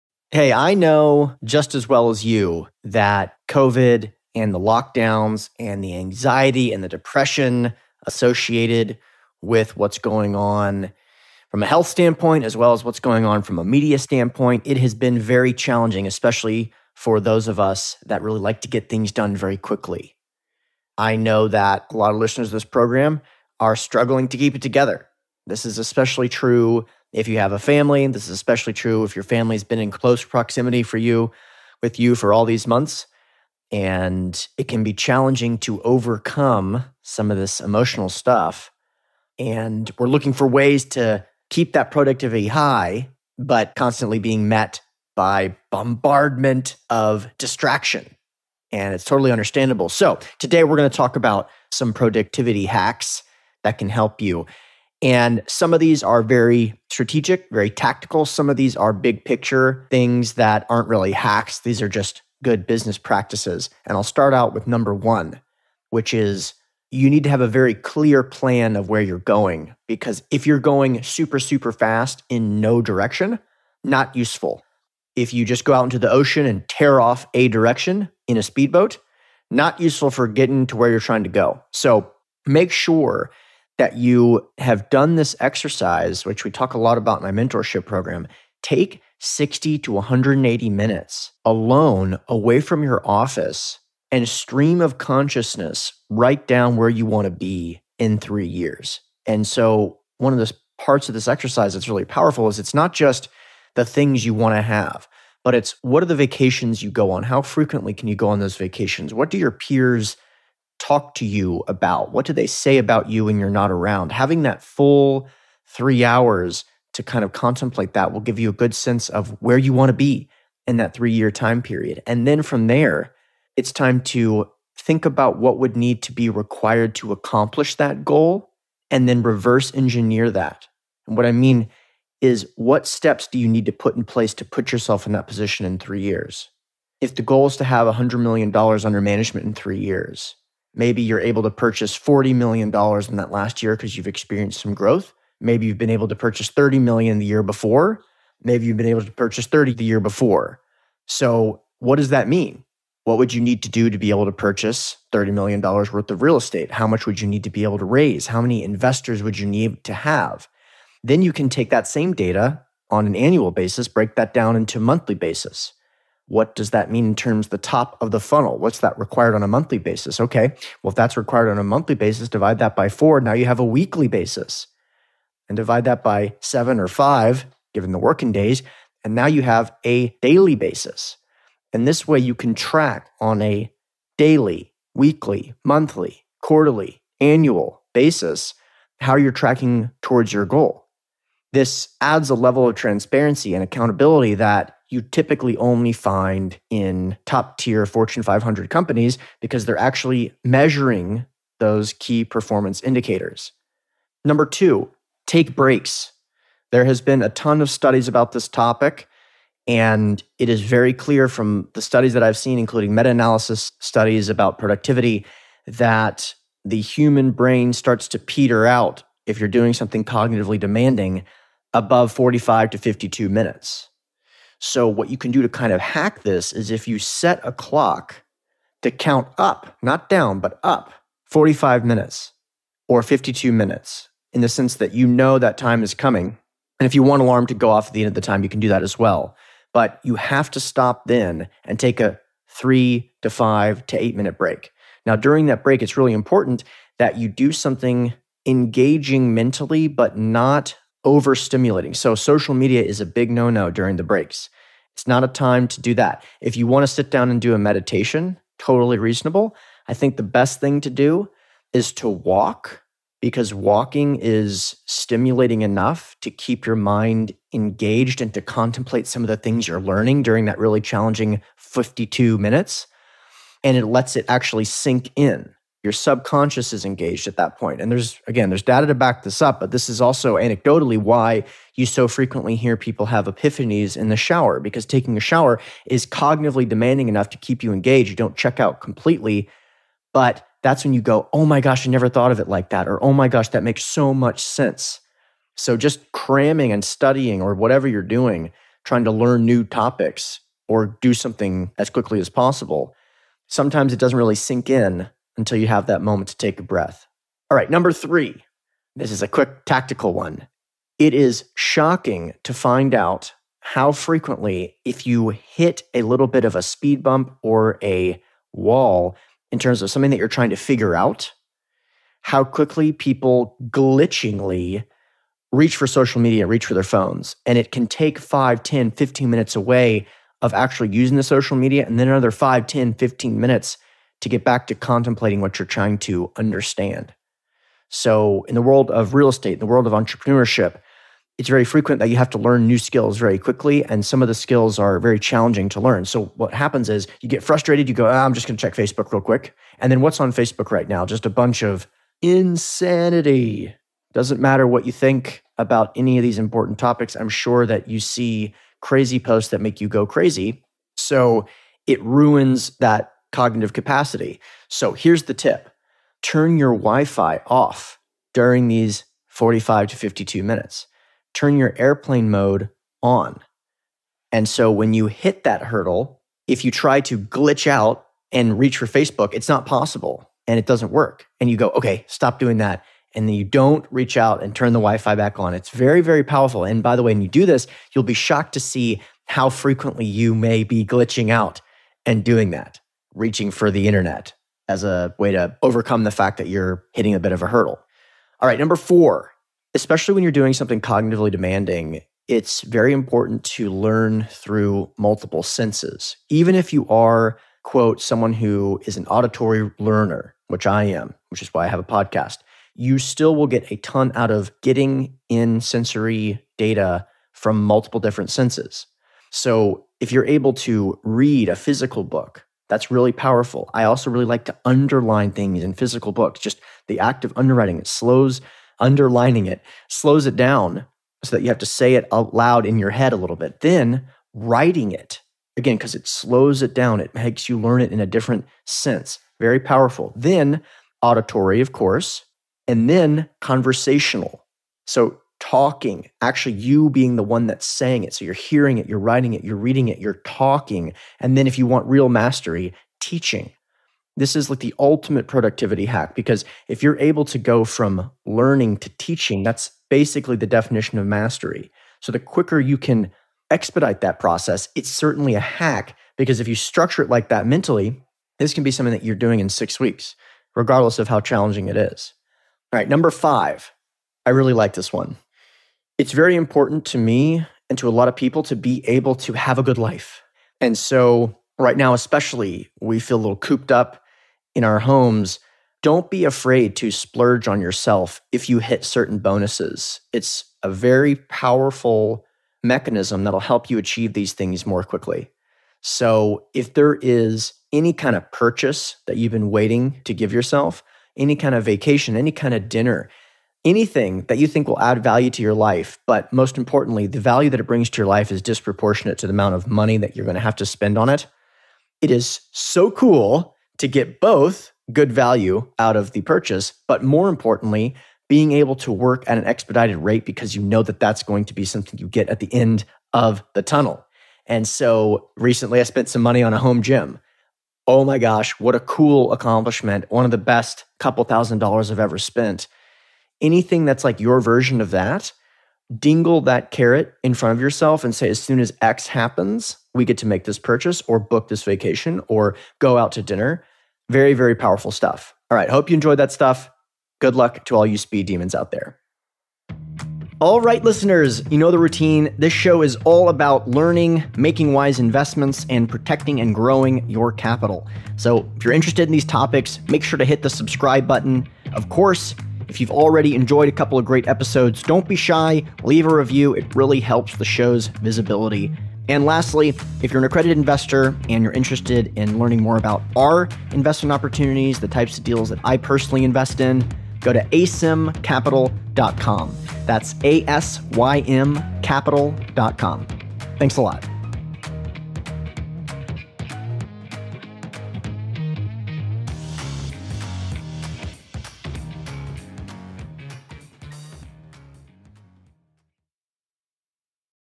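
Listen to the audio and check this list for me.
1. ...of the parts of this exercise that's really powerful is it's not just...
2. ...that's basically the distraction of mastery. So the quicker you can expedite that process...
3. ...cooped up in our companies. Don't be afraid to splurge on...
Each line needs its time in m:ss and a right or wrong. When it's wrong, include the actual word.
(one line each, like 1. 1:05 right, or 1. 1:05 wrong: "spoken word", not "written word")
1. 1:40 right
2. 7:39 wrong: "definition", not "distraction"
3. 8:03 wrong: "homes", not "companies".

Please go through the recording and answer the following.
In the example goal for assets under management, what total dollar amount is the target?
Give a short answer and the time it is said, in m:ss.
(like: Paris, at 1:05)
$100 million, at 2:17.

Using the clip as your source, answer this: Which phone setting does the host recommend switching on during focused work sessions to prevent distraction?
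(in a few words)
airplane mode.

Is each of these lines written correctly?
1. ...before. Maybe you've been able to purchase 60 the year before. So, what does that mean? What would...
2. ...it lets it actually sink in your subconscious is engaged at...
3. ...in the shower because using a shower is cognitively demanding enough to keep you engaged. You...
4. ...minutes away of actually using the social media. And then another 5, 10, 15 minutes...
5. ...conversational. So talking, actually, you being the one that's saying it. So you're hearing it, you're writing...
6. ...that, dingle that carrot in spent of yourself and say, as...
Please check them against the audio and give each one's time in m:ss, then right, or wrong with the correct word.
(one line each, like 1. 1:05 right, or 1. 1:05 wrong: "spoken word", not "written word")
1. 2:27 wrong: "30", not "60"
2. 4:33 right
3. 4:43 wrong: "taking", not "using"
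4. 5:29 right
5. 7:23 right
6. 8:54 wrong: "front", not "spent".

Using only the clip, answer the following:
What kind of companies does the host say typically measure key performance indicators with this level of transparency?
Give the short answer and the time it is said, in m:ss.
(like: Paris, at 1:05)
Fortune 500 companies, at 3:17.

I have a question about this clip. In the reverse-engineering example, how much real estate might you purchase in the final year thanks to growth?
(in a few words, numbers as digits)
$40 million.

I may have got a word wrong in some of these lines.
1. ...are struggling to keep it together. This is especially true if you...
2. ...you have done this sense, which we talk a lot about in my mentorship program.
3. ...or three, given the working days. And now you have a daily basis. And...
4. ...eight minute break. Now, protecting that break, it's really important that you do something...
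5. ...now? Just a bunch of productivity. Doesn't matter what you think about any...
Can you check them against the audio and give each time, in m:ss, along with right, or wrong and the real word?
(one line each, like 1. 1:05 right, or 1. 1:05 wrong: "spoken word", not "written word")
1. 0:23 right
2. 1:23 wrong: "exercise", not "sense"
3. 2:56 wrong: "five", not "three"
4. 4:04 wrong: "during", not "protecting"
5. 5:50 wrong: "insanity", not "productivity".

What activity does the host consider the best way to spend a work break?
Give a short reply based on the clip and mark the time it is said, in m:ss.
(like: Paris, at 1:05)
walking, at 4:22.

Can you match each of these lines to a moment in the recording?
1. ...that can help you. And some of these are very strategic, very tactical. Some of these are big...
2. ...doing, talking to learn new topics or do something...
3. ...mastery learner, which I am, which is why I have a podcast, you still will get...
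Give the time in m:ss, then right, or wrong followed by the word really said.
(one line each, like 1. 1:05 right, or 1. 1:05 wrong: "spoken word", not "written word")
1. 0:53 right
2. 4:58 wrong: "trying", not "talking"
3. 6:49 wrong: "auditory", not "mastery".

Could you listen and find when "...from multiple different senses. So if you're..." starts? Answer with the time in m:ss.
6:57.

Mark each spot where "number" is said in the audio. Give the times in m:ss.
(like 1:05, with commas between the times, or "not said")
1:04, 3:24, 5:07, 6:38, 7:52.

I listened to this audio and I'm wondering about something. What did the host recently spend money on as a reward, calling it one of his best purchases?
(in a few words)
a home gym.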